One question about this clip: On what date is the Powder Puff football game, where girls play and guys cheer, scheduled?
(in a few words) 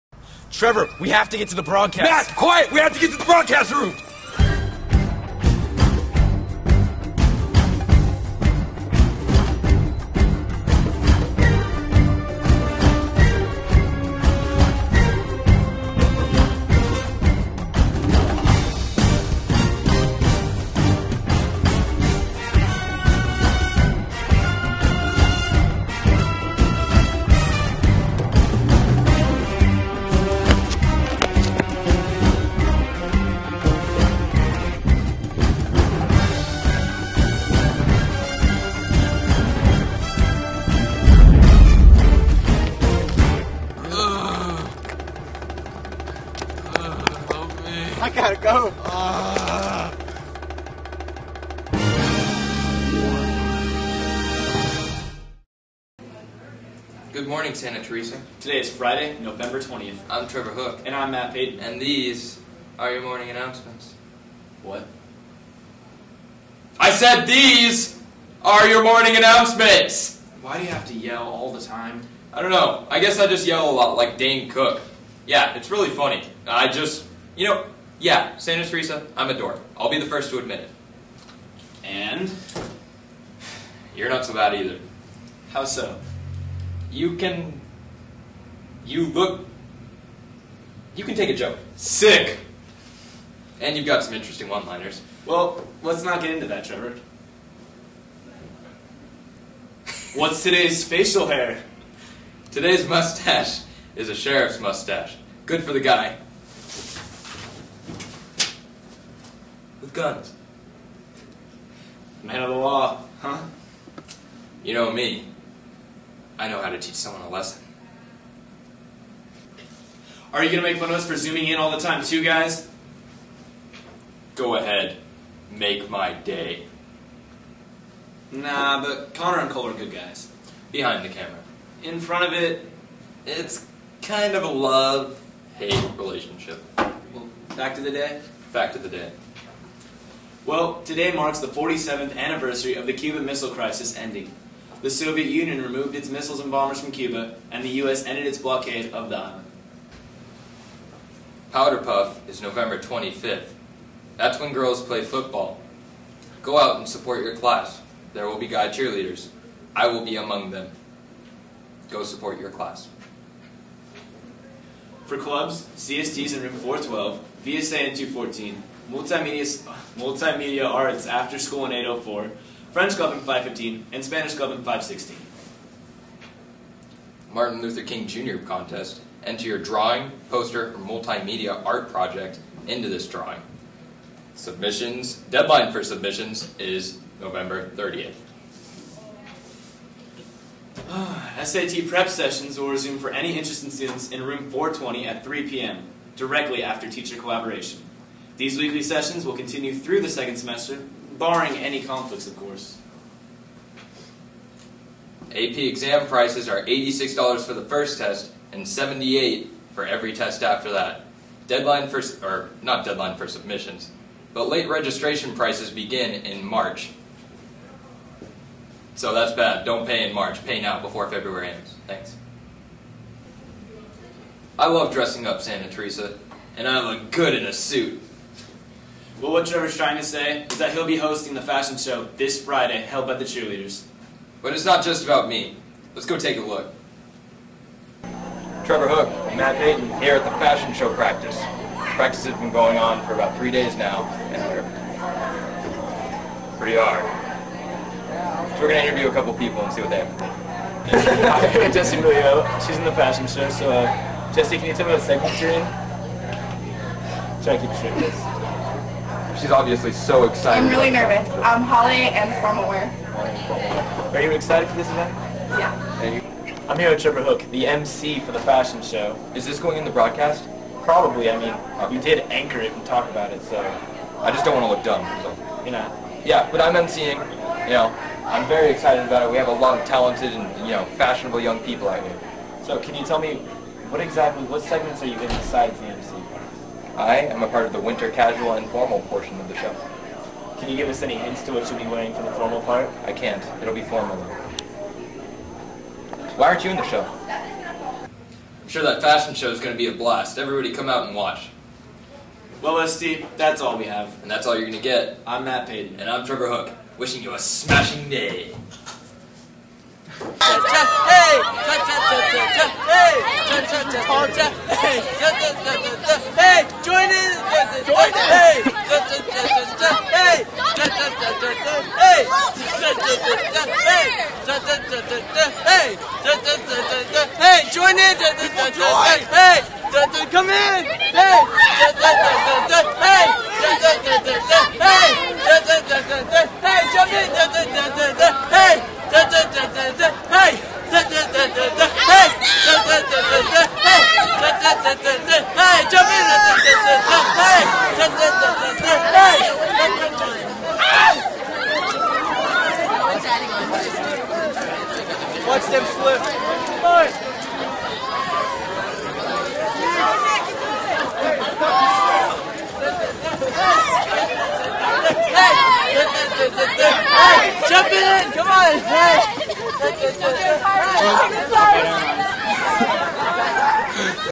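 November 25th.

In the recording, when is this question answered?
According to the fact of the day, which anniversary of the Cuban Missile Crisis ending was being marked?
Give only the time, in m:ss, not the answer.
2:21.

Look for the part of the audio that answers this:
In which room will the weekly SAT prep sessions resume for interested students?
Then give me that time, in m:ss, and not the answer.
3:14.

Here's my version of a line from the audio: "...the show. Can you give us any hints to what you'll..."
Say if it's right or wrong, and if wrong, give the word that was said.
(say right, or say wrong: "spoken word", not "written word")
right.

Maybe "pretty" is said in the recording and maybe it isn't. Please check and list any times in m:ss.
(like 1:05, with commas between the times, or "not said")
4:06.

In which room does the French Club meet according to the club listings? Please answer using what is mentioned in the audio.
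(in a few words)
Room 515.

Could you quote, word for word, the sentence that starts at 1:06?
I said these are your morning announcements!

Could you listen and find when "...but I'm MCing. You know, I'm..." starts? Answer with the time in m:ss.
4:36.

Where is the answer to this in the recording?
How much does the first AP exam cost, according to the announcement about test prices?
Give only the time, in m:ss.
3:26.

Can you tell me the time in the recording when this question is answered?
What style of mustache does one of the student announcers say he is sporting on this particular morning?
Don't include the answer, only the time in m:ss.
1:44.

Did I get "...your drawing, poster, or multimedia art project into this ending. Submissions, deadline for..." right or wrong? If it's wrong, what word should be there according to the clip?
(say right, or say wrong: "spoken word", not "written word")
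wrong: "drawing", not "ending".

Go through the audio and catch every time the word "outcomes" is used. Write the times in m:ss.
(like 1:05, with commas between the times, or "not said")
not said.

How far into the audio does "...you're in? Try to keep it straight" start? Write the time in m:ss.
4:15.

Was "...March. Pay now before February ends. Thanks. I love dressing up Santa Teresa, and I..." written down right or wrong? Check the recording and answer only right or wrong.
right.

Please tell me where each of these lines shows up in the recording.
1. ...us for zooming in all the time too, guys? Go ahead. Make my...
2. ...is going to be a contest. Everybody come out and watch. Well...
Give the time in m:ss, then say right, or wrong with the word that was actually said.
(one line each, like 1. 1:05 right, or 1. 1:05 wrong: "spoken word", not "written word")
1. 2:00 right
2. 4:59 wrong: "blast", not "contest".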